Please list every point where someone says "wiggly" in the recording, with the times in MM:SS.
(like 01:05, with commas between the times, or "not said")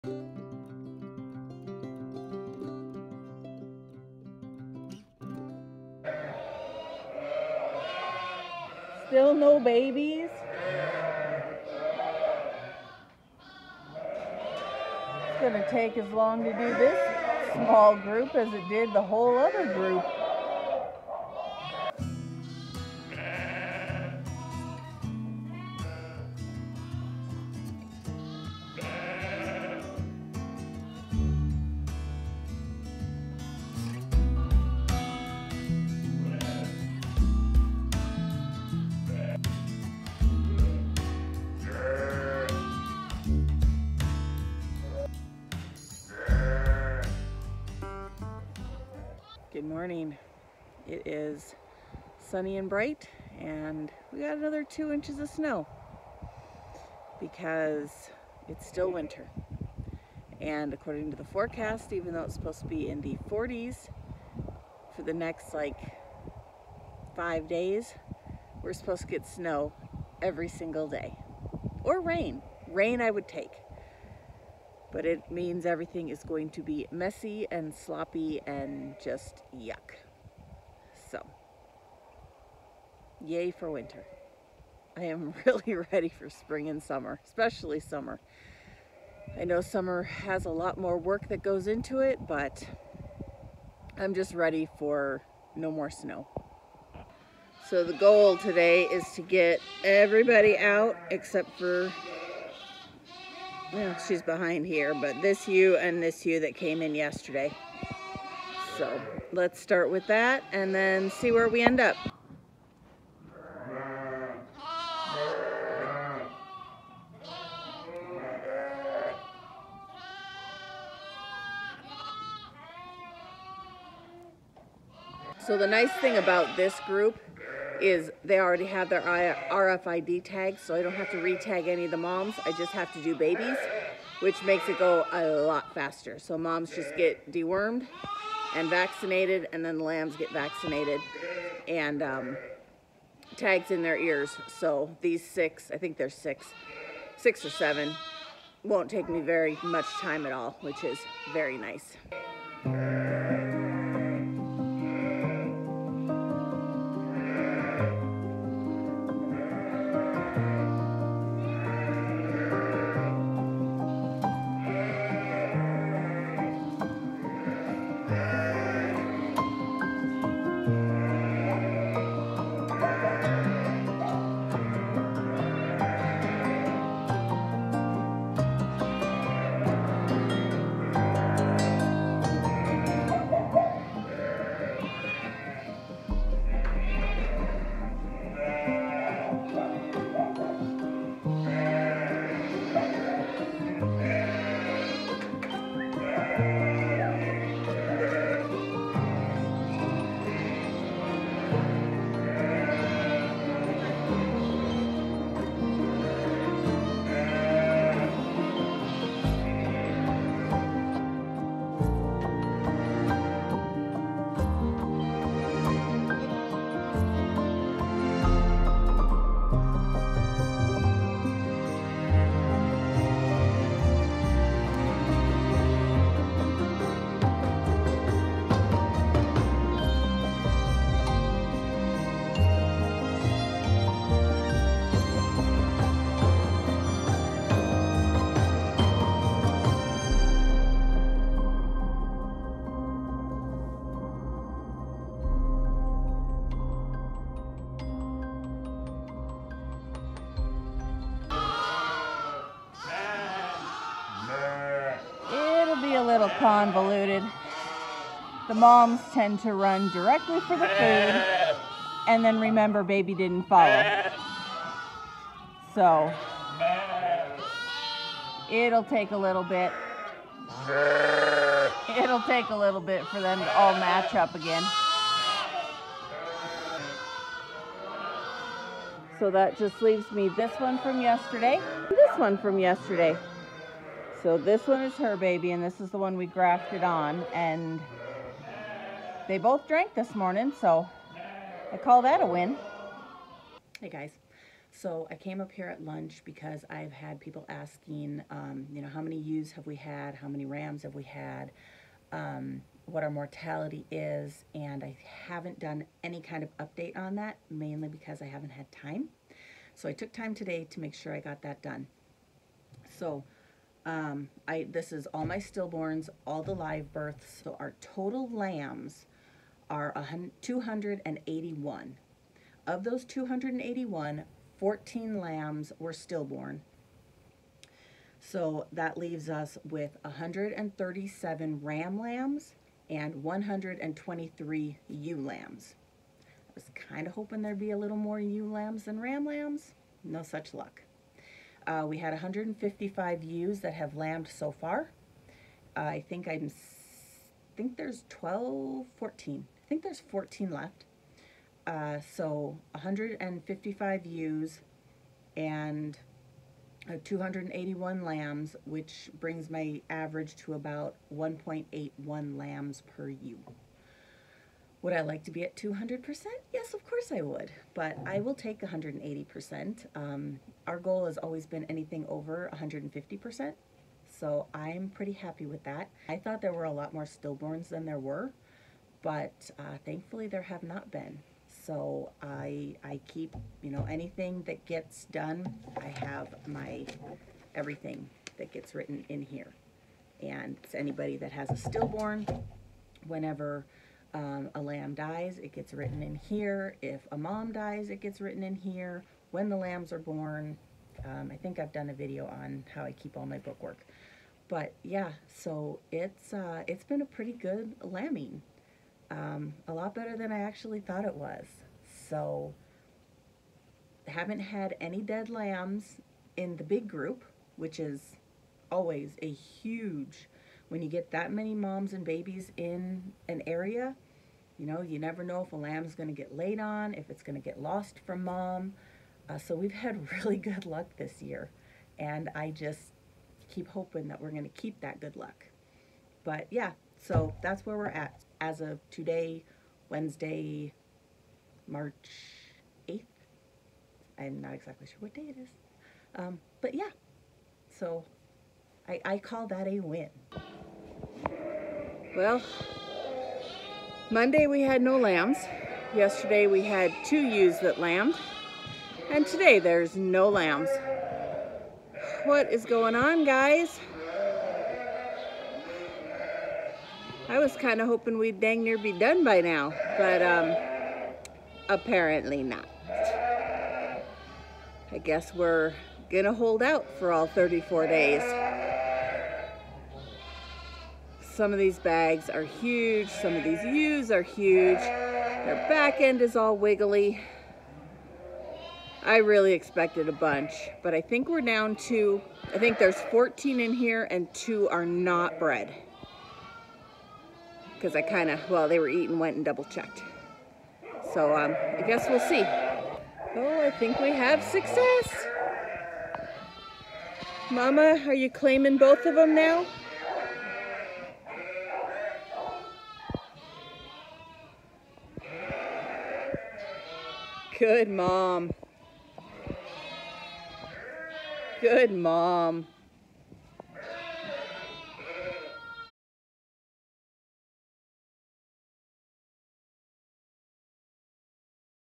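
08:06.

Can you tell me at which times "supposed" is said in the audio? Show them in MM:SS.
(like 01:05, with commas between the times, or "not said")
01:02, 01:08.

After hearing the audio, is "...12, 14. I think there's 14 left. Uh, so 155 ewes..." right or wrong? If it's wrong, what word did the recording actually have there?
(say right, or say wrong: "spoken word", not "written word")
right.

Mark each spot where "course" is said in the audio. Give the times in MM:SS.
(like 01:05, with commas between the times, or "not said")
06:06.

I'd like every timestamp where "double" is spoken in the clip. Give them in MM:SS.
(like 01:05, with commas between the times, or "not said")
08:19.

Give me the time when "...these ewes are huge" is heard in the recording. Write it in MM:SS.
08:03.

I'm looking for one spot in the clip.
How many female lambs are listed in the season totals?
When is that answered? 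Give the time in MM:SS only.
05:33.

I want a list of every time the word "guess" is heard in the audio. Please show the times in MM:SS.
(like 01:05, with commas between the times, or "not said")
07:55, 08:21.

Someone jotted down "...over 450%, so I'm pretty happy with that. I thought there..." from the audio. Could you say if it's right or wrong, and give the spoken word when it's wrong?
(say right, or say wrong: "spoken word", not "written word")
wrong: "150", not "450".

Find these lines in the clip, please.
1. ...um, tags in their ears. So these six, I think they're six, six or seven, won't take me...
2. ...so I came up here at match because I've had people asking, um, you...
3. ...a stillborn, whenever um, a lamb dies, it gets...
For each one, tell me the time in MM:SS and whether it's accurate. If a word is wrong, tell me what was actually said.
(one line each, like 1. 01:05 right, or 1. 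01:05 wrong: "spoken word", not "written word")
1. 02:22 right
2. 04:54 wrong: "lunch", not "match"
3. 06:31 right.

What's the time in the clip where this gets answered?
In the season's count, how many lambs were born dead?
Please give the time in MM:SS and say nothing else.
05:24.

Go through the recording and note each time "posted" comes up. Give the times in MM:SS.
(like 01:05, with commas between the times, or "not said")
not said.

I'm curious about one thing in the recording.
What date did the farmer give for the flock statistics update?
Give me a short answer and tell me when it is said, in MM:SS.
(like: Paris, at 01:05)
Wednesday, March 8th, at 07:19.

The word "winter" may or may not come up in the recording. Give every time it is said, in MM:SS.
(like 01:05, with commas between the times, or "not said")
00:58, 01:23.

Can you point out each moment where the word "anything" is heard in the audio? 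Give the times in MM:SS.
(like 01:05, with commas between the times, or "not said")
06:11, 06:23.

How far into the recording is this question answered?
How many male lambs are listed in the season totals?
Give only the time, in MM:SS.
05:30.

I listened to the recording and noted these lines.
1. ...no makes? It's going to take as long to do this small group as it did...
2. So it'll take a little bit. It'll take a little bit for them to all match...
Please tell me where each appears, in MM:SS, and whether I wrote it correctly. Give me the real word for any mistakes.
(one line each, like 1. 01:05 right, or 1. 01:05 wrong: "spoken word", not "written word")
1. 00:09 wrong: "babies", not "makes"
2. 04:25 right.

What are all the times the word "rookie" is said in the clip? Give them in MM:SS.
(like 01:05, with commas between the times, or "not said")
not said.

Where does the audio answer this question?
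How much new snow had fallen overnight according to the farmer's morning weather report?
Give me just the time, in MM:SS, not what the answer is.
00:54.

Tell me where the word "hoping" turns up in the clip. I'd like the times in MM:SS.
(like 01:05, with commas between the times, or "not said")
05:37, 07:13, 07:47.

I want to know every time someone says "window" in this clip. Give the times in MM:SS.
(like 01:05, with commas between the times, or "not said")
not said.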